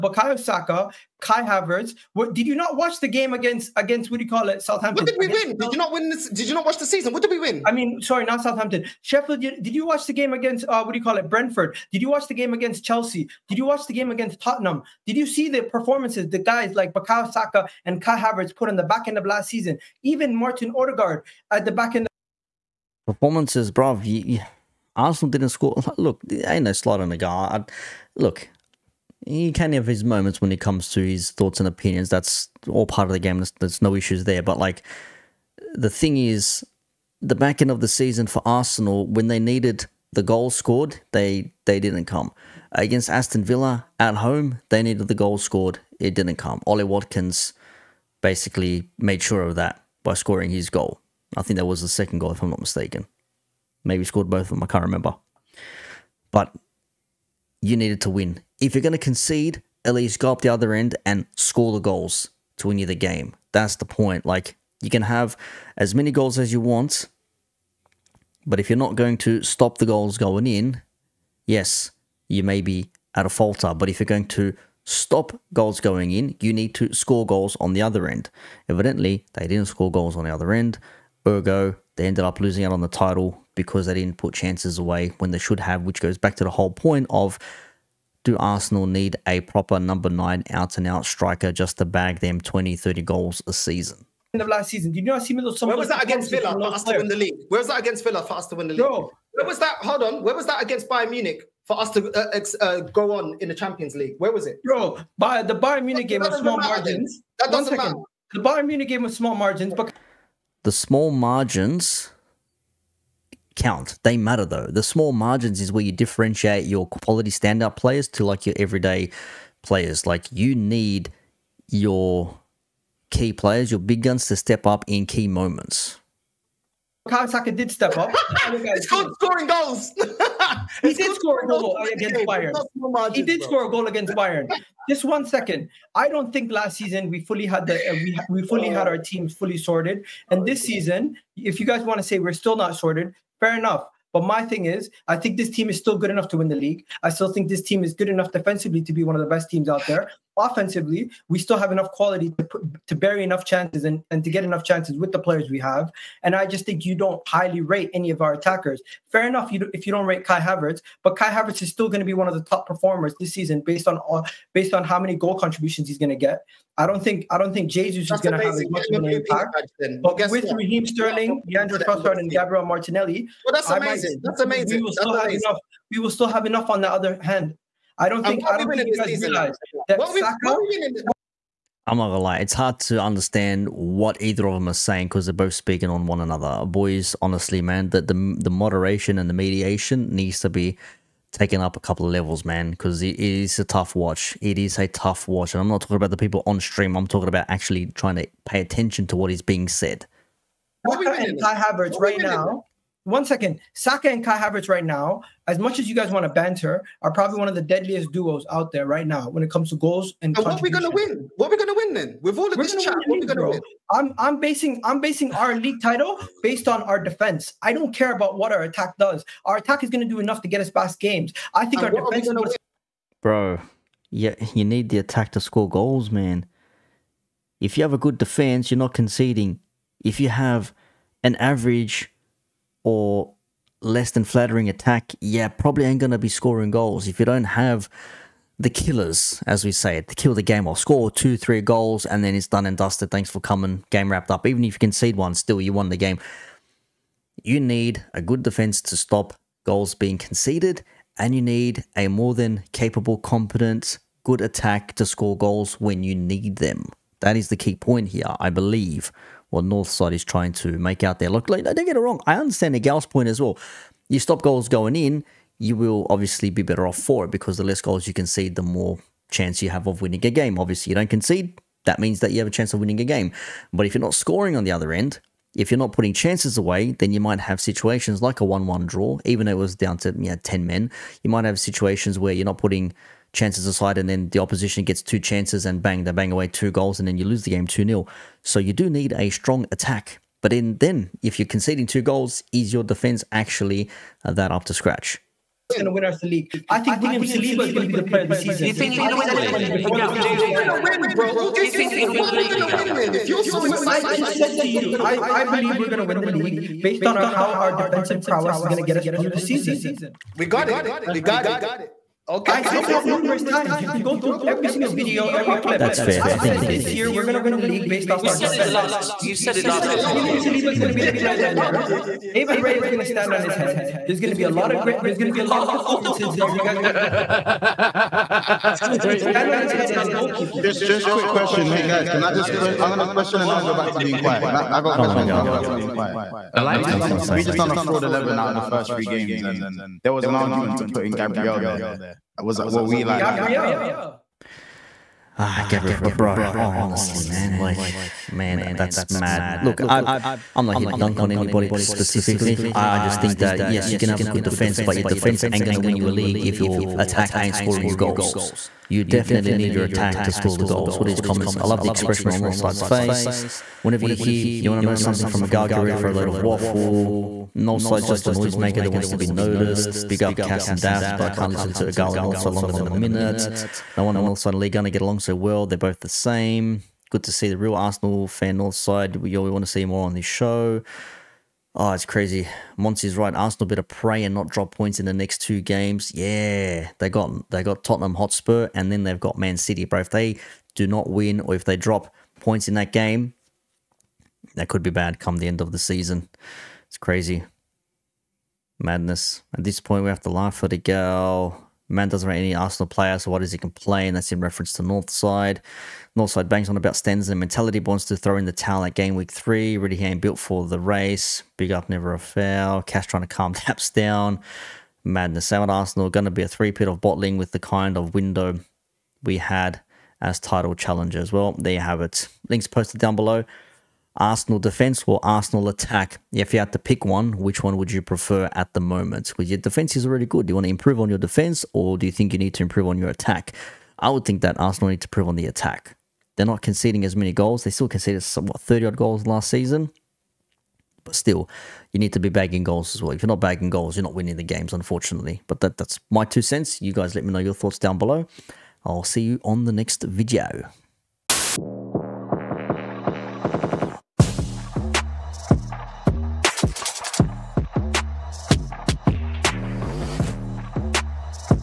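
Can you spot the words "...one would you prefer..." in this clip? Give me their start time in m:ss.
7:07.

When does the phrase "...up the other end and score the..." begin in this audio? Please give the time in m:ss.
1:00.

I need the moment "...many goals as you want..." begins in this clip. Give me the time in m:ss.
1:05.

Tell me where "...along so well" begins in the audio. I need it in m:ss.
6:15.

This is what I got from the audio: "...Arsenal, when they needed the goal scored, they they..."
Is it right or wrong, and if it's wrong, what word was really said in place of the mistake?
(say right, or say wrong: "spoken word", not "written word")
right.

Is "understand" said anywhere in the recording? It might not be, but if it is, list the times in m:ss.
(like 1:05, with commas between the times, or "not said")
3:03, 4:22.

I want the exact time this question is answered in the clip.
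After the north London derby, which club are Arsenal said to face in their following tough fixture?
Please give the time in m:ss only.
6:29.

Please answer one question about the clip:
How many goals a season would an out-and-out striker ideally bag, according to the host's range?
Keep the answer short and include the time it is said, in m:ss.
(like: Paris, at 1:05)
20 to 30, at 1:32.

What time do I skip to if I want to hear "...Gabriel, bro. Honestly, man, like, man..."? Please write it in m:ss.
5:45.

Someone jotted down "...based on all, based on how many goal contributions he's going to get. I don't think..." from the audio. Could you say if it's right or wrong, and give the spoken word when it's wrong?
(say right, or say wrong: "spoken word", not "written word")
right.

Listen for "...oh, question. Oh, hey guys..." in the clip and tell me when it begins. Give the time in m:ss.
5:31.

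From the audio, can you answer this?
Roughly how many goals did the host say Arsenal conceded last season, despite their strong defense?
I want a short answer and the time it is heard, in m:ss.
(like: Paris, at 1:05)
30, at 7:18.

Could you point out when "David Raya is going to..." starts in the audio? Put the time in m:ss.
5:22.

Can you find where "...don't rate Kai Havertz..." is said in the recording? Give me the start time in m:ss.
2:39.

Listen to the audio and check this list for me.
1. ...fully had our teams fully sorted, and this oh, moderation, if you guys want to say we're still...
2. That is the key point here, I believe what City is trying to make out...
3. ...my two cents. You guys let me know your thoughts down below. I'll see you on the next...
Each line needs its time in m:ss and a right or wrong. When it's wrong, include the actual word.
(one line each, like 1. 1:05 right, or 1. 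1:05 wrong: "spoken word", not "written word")
1. 2:18 wrong: "season", not "moderation"
2. 4:17 wrong: "Northside", not "City"
3. 7:26 right.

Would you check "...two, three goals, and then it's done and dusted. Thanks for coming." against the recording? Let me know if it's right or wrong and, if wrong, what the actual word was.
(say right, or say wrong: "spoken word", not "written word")
right.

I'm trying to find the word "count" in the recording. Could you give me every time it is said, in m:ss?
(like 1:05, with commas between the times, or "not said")
1:53.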